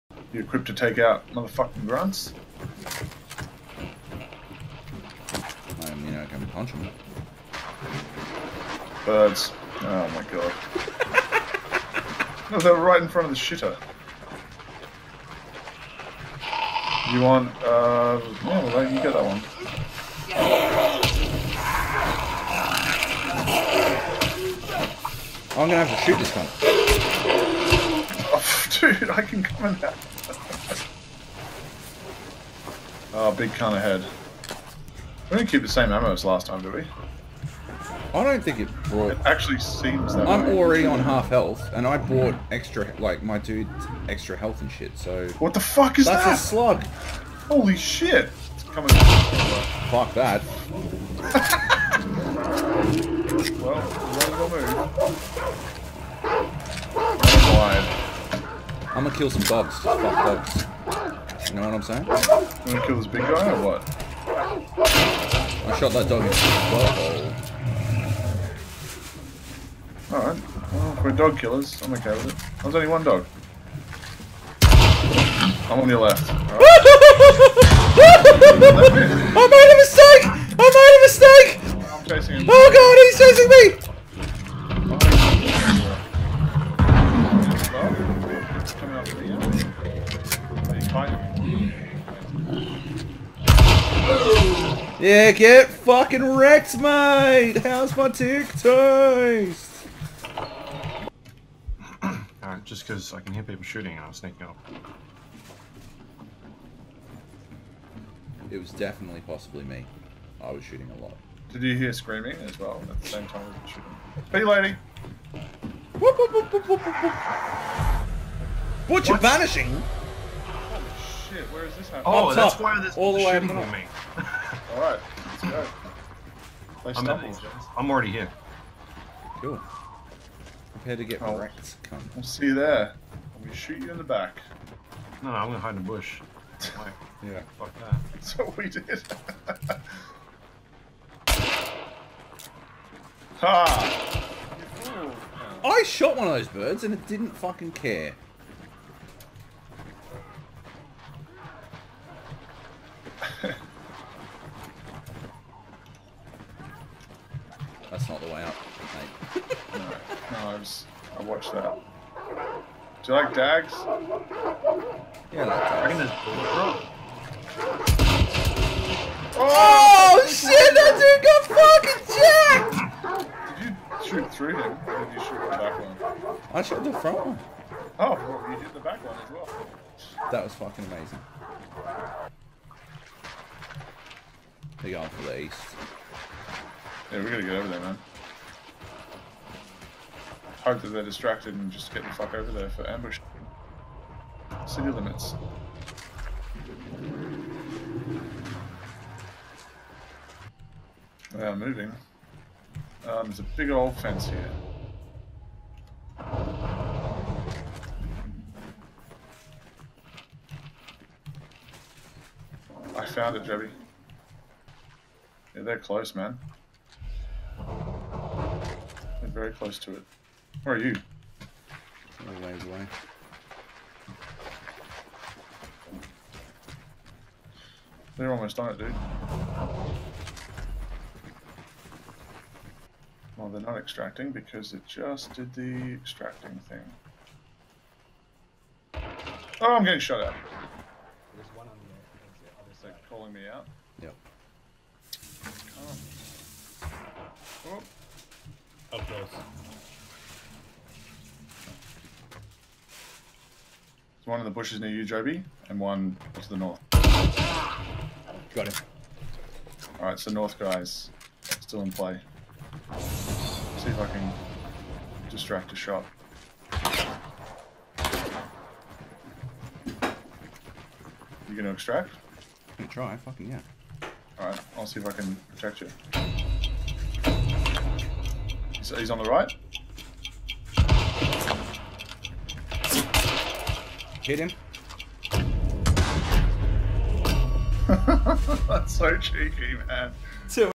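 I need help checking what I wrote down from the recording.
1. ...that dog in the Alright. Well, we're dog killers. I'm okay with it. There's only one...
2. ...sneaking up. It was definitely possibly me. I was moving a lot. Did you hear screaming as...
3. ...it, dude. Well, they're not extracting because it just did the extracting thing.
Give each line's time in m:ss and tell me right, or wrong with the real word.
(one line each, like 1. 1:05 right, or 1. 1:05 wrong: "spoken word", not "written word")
1. 1:05 right
2. 1:44 wrong: "shooting", not "moving"
3. 3:48 right.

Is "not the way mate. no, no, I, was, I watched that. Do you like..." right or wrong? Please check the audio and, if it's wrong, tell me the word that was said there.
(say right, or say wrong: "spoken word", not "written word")
right.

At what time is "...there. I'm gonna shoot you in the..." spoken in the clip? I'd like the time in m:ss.
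2:12.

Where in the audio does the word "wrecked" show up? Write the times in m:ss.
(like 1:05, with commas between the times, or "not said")
1:36, 2:11.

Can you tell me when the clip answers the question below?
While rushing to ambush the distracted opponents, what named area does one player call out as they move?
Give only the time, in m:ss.
3:14.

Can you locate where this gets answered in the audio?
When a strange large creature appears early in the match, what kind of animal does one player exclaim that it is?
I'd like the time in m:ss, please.
0:46.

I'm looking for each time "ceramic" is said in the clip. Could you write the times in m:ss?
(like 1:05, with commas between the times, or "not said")
not said.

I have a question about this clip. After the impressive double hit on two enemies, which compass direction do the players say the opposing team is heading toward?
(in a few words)
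East.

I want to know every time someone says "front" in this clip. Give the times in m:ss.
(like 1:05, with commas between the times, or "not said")
0:13, 2:56.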